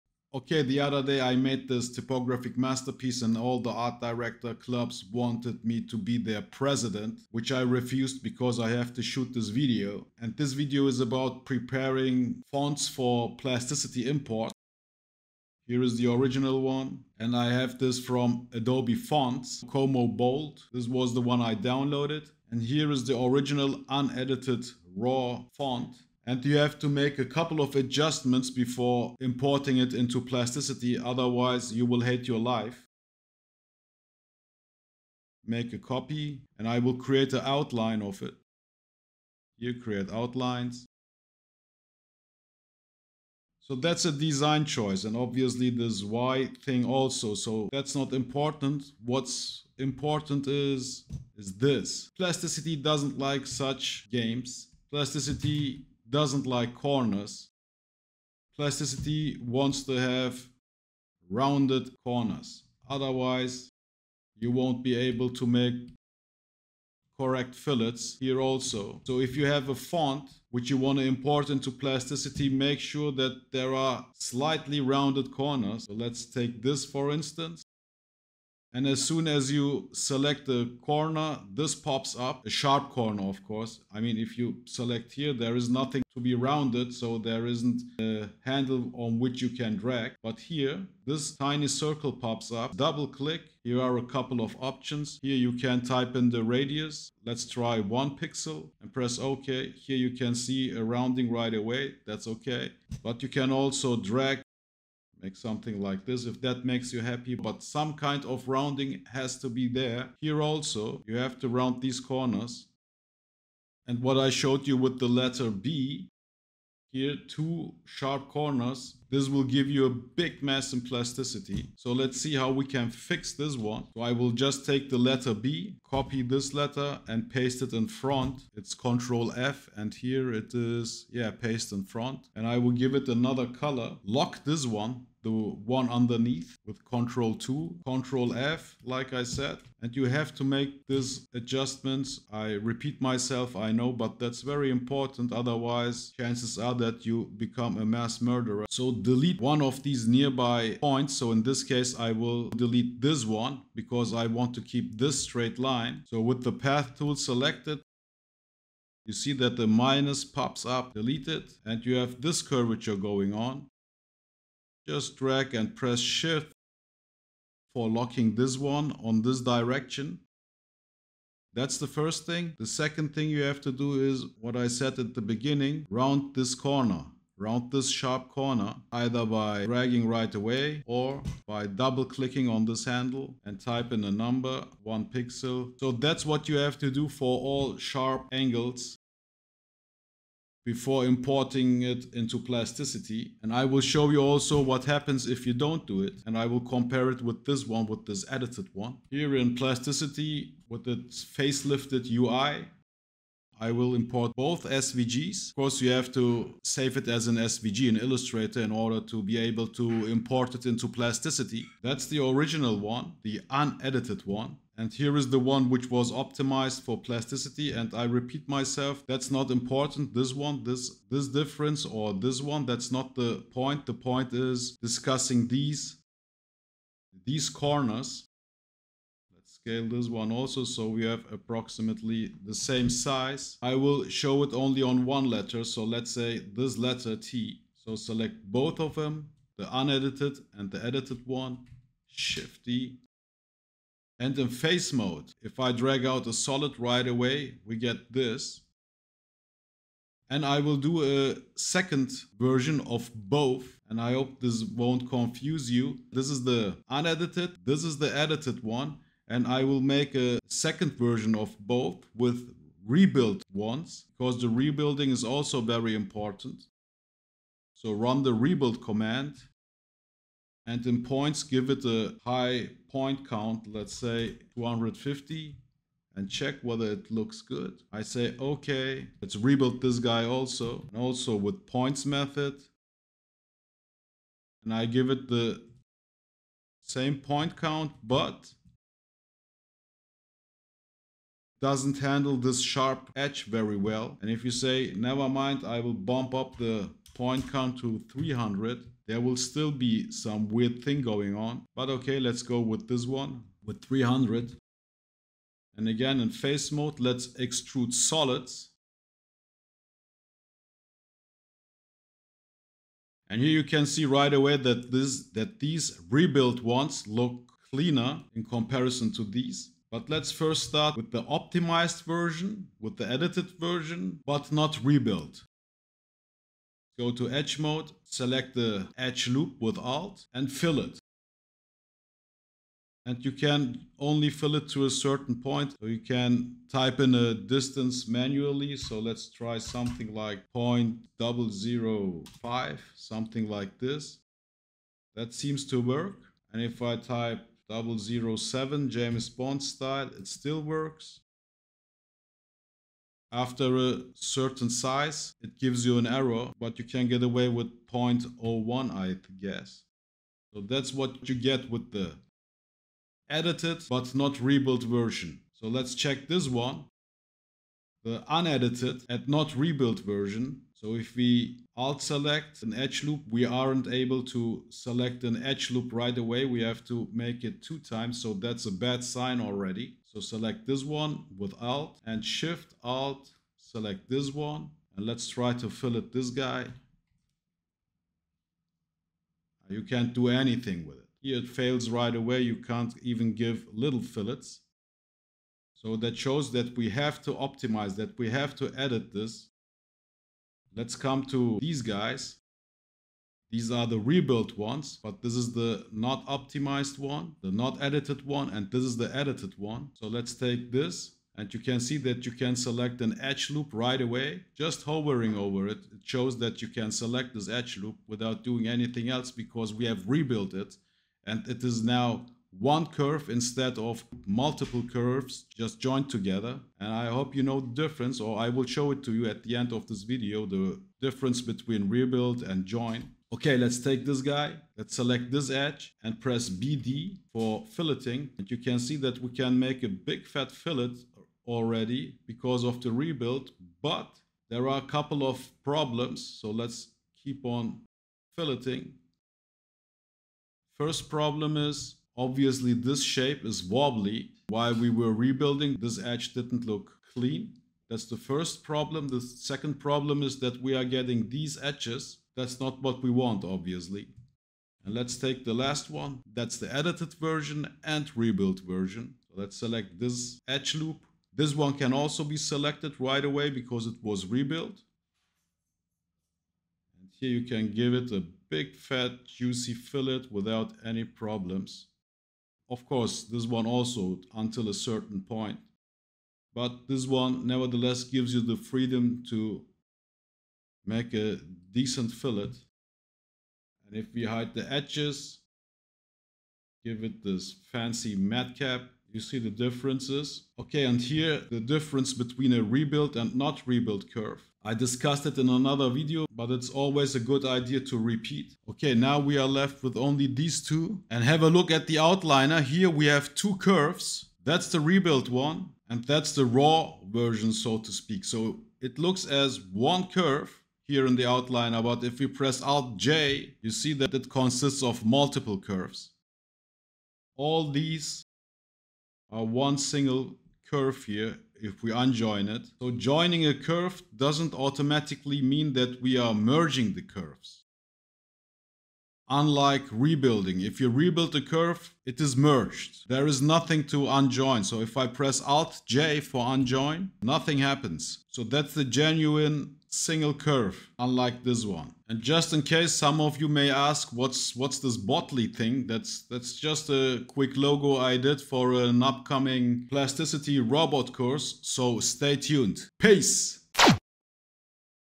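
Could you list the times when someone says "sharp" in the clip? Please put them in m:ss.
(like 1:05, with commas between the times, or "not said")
1:22, 1:57, 2:57, 3:07, 4:52.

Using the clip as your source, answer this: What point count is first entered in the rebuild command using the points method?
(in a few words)
250.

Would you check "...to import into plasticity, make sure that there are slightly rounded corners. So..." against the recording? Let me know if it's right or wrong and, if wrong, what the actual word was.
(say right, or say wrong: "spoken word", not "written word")
right.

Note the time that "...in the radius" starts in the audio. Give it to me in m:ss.
1:36.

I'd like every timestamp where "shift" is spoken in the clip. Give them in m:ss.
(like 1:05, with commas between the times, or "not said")
2:45, 4:02, 6:22.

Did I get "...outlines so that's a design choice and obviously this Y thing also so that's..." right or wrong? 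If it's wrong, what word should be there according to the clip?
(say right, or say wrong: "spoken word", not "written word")
right.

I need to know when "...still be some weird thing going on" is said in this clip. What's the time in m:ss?
4:59.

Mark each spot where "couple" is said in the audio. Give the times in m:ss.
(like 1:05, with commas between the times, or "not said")
0:27, 1:34, 7:24.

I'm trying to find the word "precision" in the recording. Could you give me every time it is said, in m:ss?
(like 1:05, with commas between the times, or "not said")
not said.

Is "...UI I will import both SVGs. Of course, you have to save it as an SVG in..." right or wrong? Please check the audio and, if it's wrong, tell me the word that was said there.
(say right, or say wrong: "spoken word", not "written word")
right.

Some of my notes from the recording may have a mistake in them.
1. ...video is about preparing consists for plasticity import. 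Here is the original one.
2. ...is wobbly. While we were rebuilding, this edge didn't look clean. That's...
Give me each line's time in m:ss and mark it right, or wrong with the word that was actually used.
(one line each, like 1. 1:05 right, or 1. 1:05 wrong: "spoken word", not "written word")
1. 0:10 wrong: "fonts", not "consists"
2. 7:33 right.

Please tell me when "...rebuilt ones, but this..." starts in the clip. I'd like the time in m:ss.
6:43.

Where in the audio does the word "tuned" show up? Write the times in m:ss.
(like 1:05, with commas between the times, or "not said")
9:22.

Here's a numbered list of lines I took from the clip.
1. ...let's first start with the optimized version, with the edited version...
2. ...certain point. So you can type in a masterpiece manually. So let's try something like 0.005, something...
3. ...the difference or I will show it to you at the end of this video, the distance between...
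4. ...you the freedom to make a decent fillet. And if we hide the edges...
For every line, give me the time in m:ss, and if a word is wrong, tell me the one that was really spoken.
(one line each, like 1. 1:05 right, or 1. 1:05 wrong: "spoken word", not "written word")
1. 5:20 right
2. 5:34 wrong: "distance", not "masterpiece"
3. 7:07 wrong: "difference", not "distance"
4. 8:08 right.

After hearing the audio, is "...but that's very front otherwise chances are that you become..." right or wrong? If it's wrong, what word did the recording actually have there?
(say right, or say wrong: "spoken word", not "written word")
wrong: "important", not "front".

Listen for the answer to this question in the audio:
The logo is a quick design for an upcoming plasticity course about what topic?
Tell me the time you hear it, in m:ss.
9:20.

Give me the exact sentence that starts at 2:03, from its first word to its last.
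So I will just take the letter B, copy this letter and paste it in front.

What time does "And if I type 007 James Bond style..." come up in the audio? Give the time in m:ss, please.
5:46.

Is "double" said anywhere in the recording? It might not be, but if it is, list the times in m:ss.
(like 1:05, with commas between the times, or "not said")
1:32, 3:01.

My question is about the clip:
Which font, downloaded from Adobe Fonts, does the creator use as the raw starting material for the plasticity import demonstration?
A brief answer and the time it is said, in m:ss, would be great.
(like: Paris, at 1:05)
Como Bold, at 0:19.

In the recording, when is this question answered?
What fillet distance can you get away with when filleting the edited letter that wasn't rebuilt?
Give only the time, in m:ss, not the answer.
5:57.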